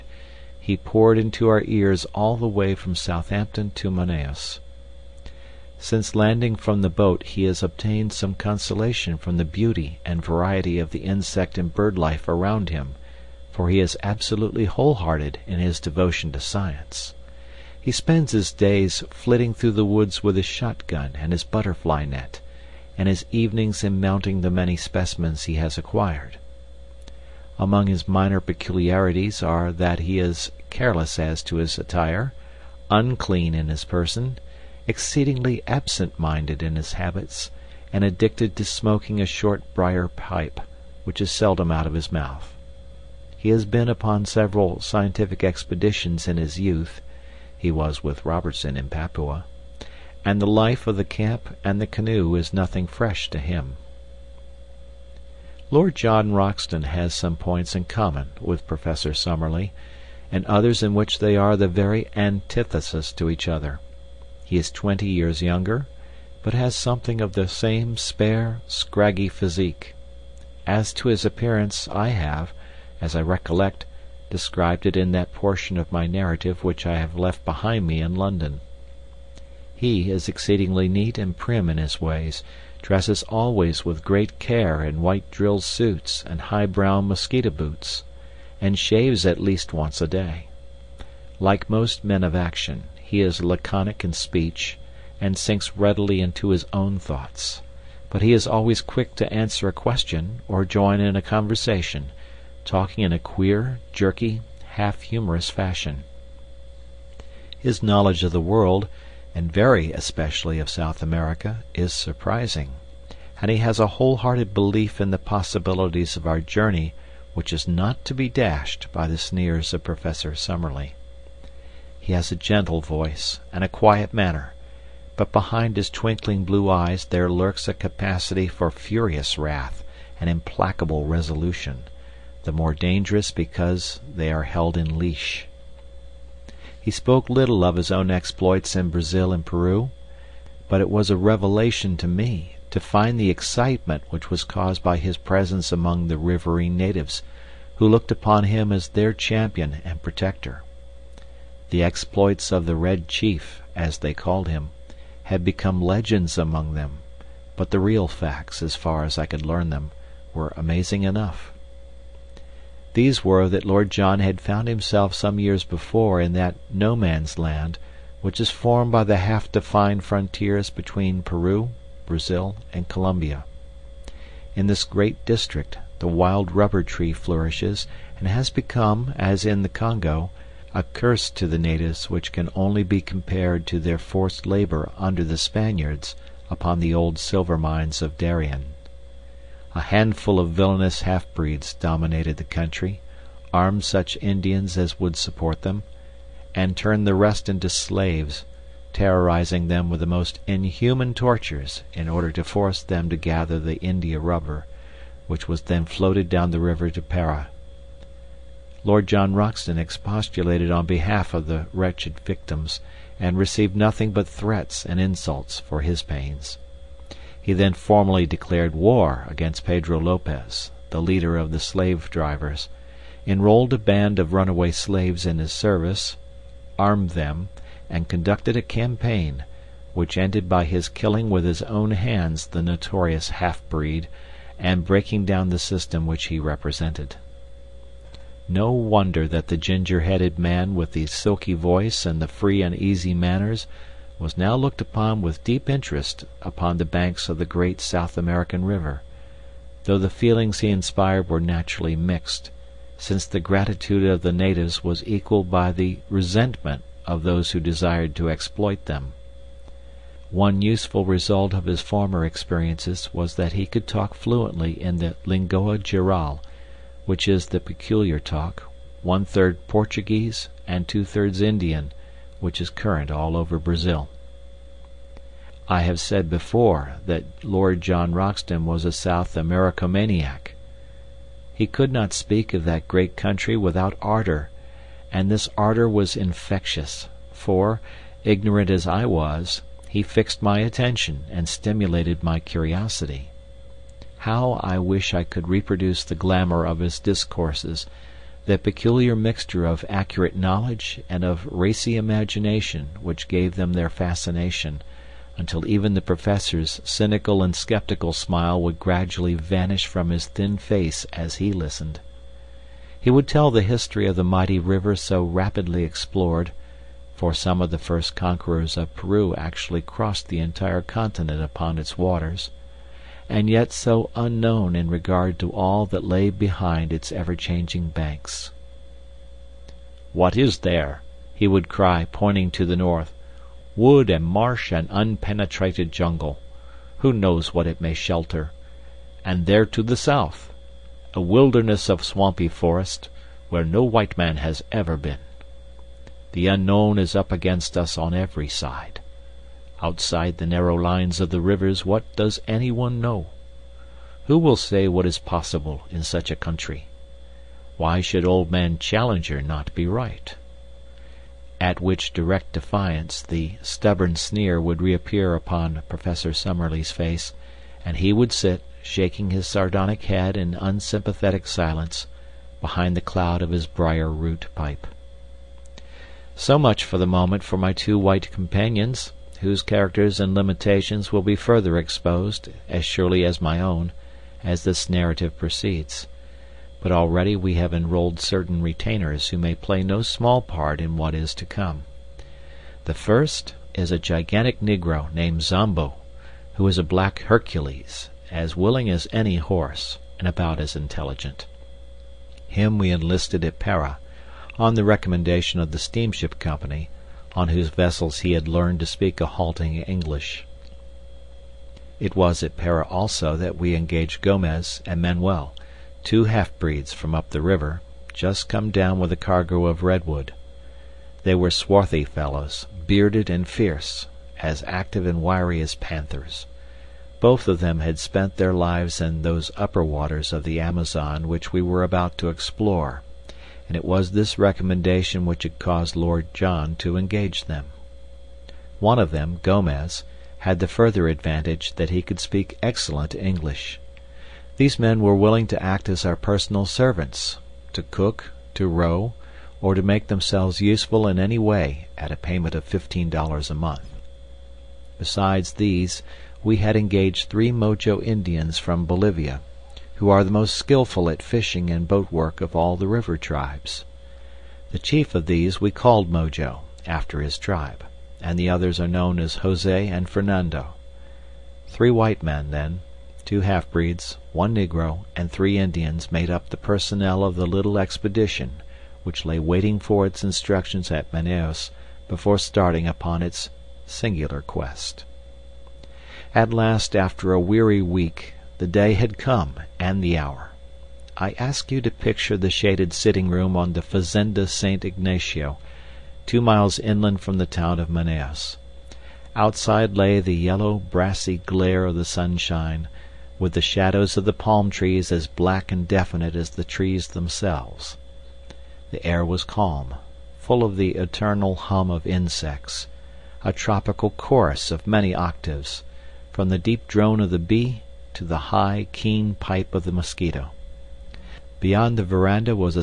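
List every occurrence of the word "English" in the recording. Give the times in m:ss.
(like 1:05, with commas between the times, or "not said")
6:49, 7:23.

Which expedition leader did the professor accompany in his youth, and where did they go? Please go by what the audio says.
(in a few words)
Robertson in Papua.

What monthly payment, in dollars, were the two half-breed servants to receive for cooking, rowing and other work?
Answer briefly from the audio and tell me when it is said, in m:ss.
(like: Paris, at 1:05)
15 dollars, at 7:32.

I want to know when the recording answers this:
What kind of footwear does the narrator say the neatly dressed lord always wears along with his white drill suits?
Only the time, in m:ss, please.
1:26.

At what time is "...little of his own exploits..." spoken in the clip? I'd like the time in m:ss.
2:17.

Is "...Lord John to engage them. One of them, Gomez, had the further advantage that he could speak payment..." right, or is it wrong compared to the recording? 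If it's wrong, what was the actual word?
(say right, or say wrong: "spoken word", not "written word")
wrong: "excellent", not "payment".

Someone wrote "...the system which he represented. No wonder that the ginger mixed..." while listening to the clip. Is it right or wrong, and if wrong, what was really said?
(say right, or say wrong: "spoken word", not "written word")
wrong: "headed", not "mixed".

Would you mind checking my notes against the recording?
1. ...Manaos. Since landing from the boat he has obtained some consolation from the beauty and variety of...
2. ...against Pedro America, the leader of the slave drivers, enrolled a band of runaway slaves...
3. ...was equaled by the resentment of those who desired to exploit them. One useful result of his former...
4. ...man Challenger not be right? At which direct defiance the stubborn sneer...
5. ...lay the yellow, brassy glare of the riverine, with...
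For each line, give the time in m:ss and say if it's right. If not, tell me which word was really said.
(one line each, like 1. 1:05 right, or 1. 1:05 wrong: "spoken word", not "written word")
1. 0:03 right
2. 3:39 wrong: "Lopez", not "America"
3. 4:14 right
4. 5:58 right
5. 8:19 wrong: "sunshine", not "riverine".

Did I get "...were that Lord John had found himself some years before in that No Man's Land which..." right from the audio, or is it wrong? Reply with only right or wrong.
right.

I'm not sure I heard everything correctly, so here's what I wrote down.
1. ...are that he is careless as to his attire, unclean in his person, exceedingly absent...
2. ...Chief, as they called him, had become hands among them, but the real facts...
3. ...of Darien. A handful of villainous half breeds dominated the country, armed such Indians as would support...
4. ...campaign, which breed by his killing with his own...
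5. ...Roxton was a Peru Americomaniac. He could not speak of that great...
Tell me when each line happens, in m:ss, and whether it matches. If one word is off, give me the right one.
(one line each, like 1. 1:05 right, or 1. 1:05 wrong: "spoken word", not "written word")
1. 0:29 right
2. 2:33 wrong: "legends", not "hands"
3. 3:08 right
4. 3:48 wrong: "ended", not "breed"
5. 4:38 wrong: "South", not "Peru".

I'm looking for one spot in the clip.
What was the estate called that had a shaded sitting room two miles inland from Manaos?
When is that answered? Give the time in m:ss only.
8:13.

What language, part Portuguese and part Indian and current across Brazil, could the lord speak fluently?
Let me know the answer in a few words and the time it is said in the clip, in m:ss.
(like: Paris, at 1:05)
Lingua Geral, at 4:25.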